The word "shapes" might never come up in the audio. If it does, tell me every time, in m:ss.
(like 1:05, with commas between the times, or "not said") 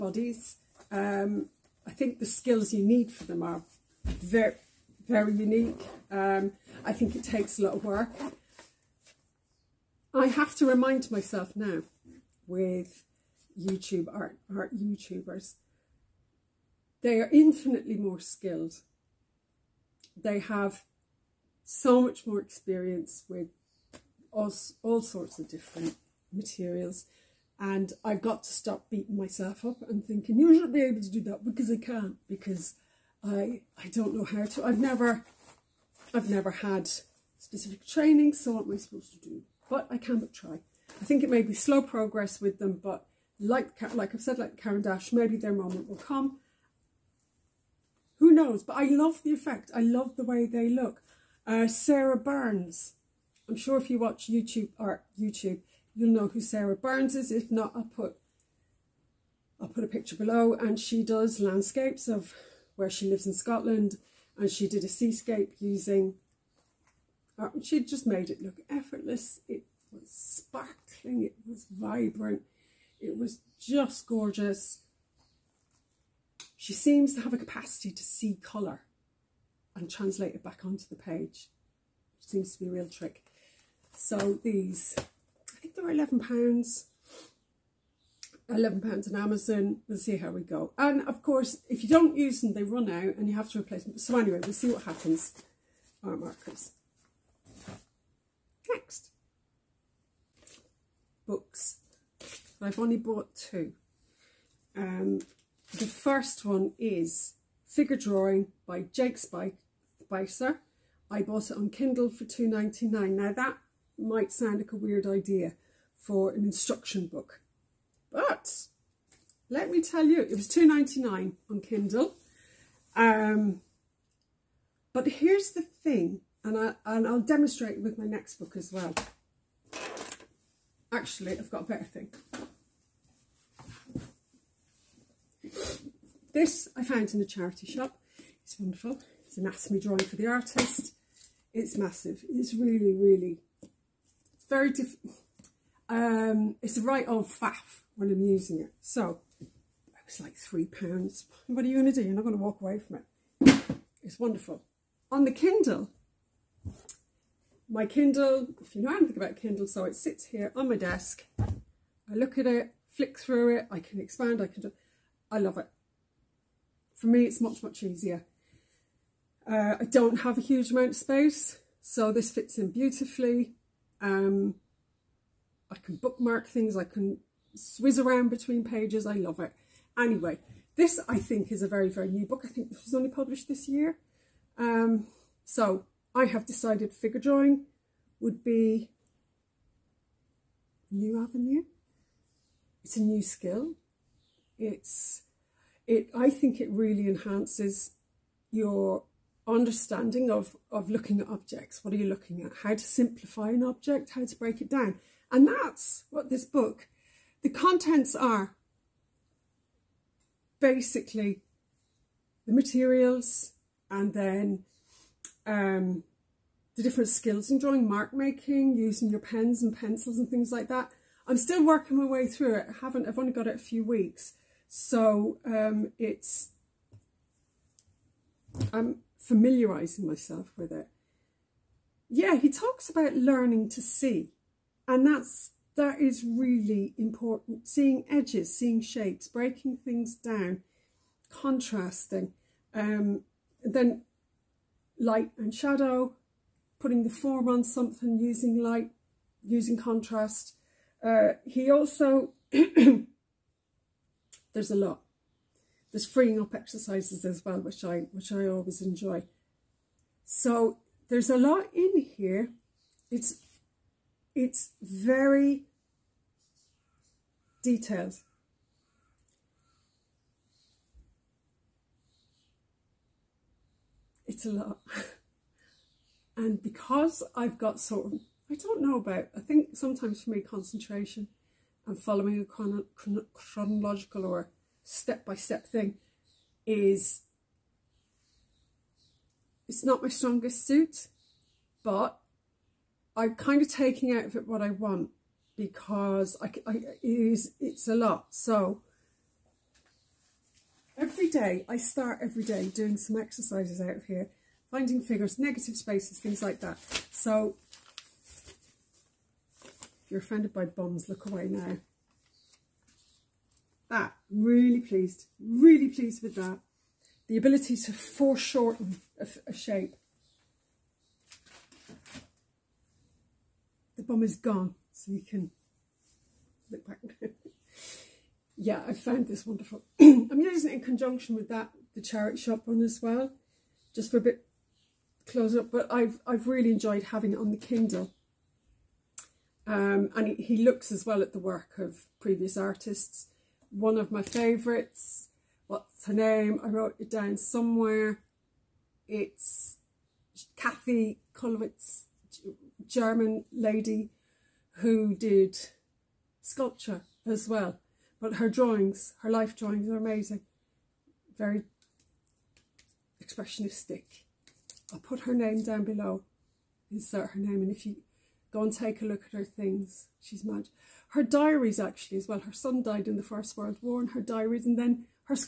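3:58, 5:19.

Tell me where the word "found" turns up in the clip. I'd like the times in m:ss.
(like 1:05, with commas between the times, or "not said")
2:16, 5:28.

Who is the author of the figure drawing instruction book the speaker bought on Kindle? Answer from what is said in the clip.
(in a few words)
Jake Spicer.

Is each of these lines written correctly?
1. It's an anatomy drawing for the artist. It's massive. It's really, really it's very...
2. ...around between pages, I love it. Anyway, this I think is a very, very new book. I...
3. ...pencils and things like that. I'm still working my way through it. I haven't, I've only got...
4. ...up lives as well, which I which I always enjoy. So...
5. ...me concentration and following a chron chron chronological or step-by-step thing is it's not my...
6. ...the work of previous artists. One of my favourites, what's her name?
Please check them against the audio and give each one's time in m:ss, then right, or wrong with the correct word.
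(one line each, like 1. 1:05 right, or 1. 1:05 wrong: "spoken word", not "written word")
1. 2:19 right
2. 2:58 right
3. 3:39 right
4. 4:16 wrong: "exercises", not "lives"
5. 4:40 right
6. 5:41 right.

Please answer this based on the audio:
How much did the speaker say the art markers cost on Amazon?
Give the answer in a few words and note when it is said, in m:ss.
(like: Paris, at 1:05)
£11, at 1:28.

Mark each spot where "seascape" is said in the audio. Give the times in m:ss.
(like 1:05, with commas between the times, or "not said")
1:04.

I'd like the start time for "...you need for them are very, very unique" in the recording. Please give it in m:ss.
0:02.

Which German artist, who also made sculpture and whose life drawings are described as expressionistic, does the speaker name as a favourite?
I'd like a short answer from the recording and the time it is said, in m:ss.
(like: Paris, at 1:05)
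Kathy Kollwitz, at 5:50.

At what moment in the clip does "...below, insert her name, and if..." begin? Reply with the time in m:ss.
6:05.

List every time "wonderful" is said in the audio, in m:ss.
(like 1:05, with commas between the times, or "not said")
2:18, 2:34, 5:29.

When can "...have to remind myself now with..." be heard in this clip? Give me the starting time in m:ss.
0:10.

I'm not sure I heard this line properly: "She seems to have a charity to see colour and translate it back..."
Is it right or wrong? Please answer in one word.
wrong.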